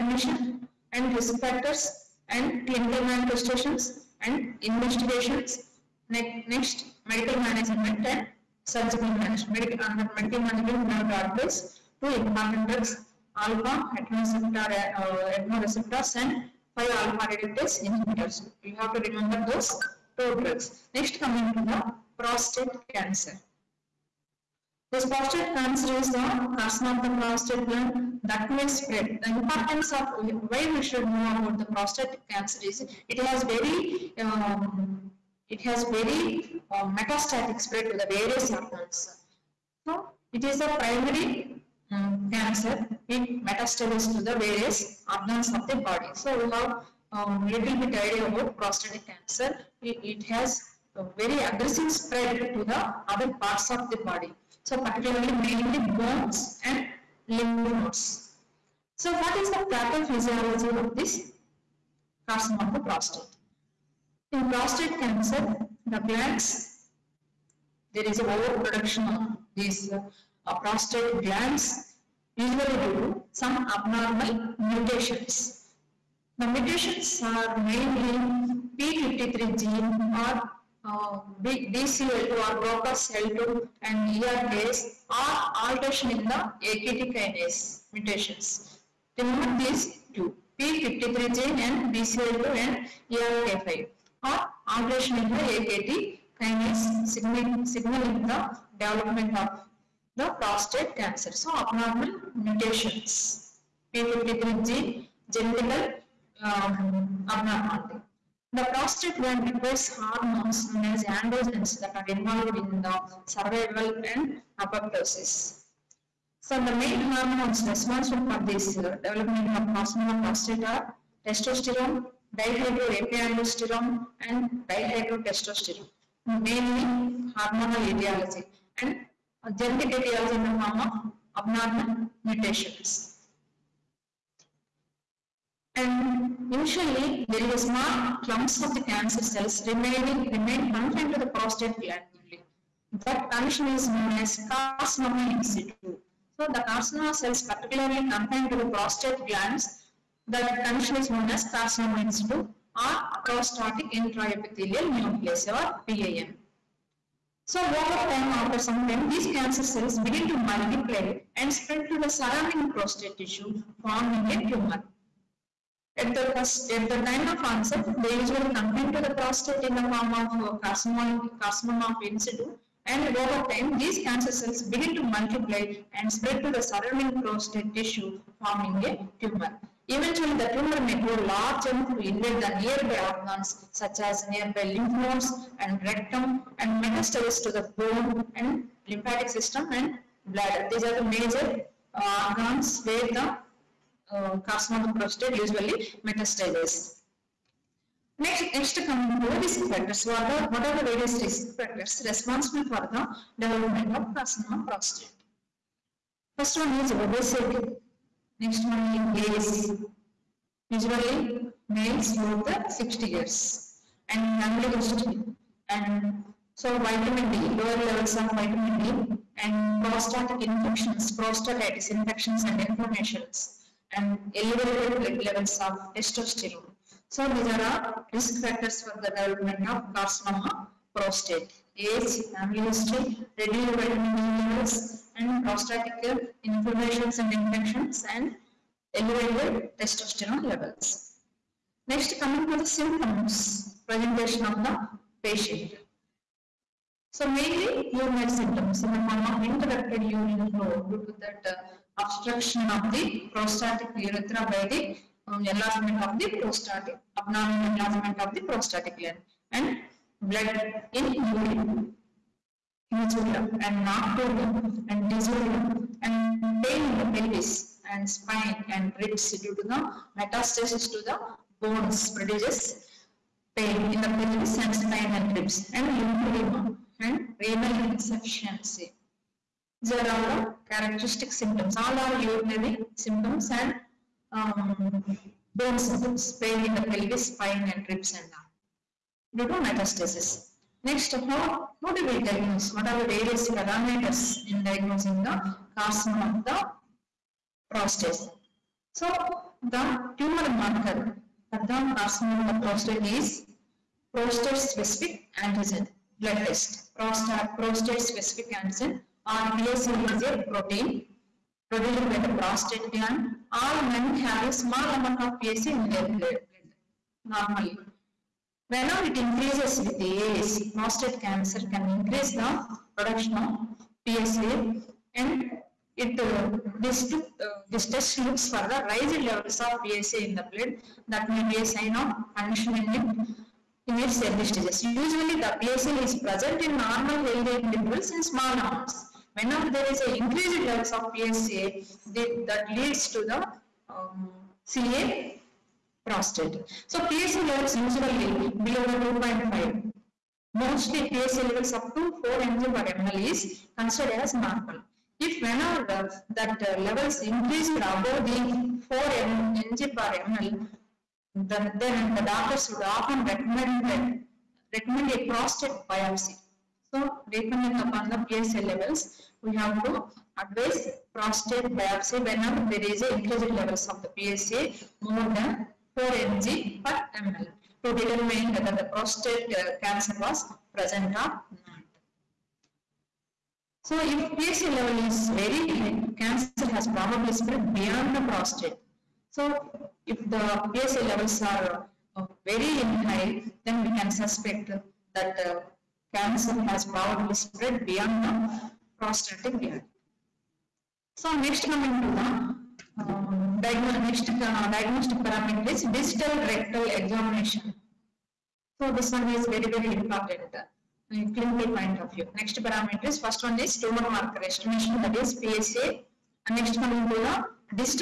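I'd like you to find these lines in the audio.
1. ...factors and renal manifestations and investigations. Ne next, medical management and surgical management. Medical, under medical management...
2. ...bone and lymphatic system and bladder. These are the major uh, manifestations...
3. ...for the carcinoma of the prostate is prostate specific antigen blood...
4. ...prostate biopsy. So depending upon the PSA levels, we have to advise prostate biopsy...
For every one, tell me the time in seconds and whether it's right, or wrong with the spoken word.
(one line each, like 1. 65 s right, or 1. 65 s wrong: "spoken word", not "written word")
1. 1 s wrong: "clinical", not "renal"
2. 187 s wrong: "organs", not "manifestations"
3. 301 s right
4. 365 s right.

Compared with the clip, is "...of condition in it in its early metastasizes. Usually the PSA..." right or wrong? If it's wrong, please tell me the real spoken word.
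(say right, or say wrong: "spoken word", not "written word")
wrong: "stages", not "metastasizes".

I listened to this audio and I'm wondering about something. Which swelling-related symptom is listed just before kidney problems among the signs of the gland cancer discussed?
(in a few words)
lymphedema.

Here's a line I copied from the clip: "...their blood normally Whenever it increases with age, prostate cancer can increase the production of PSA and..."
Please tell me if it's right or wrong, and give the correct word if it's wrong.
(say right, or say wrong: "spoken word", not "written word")
right.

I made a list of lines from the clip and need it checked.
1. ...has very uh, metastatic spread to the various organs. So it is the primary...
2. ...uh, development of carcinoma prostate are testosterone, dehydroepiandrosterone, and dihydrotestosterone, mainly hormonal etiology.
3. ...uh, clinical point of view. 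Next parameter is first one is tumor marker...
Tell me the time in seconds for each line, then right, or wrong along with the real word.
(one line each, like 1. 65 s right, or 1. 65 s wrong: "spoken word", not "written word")
1. 35 s right
2. 118 s right
3. 410 s right.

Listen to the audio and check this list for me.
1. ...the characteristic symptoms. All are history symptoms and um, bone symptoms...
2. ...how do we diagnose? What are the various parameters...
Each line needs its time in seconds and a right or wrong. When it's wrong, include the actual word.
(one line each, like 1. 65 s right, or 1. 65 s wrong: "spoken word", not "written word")
1. 280 s wrong: "urinary", not "history"
2. 291 s right.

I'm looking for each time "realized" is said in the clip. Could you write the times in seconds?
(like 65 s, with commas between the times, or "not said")
not said.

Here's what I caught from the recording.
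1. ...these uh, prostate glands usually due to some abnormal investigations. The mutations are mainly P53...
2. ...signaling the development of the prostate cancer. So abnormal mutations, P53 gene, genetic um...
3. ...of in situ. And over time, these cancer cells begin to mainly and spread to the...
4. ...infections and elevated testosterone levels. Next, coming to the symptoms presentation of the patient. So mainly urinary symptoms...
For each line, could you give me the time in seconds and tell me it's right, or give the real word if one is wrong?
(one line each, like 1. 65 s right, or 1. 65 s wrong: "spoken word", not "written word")
1. 69 s wrong: "mutations", not "investigations"
2. 97 s right
3. 171 s wrong: "multiply", not "mainly"
4. 237 s right.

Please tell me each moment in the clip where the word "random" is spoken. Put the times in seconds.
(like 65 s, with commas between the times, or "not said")
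not said.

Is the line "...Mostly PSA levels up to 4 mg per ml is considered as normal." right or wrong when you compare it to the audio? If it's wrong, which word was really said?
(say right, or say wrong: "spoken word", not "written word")
right.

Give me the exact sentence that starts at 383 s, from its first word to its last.
So if PSA level is very high, cancer has probably spread beyond the prostate.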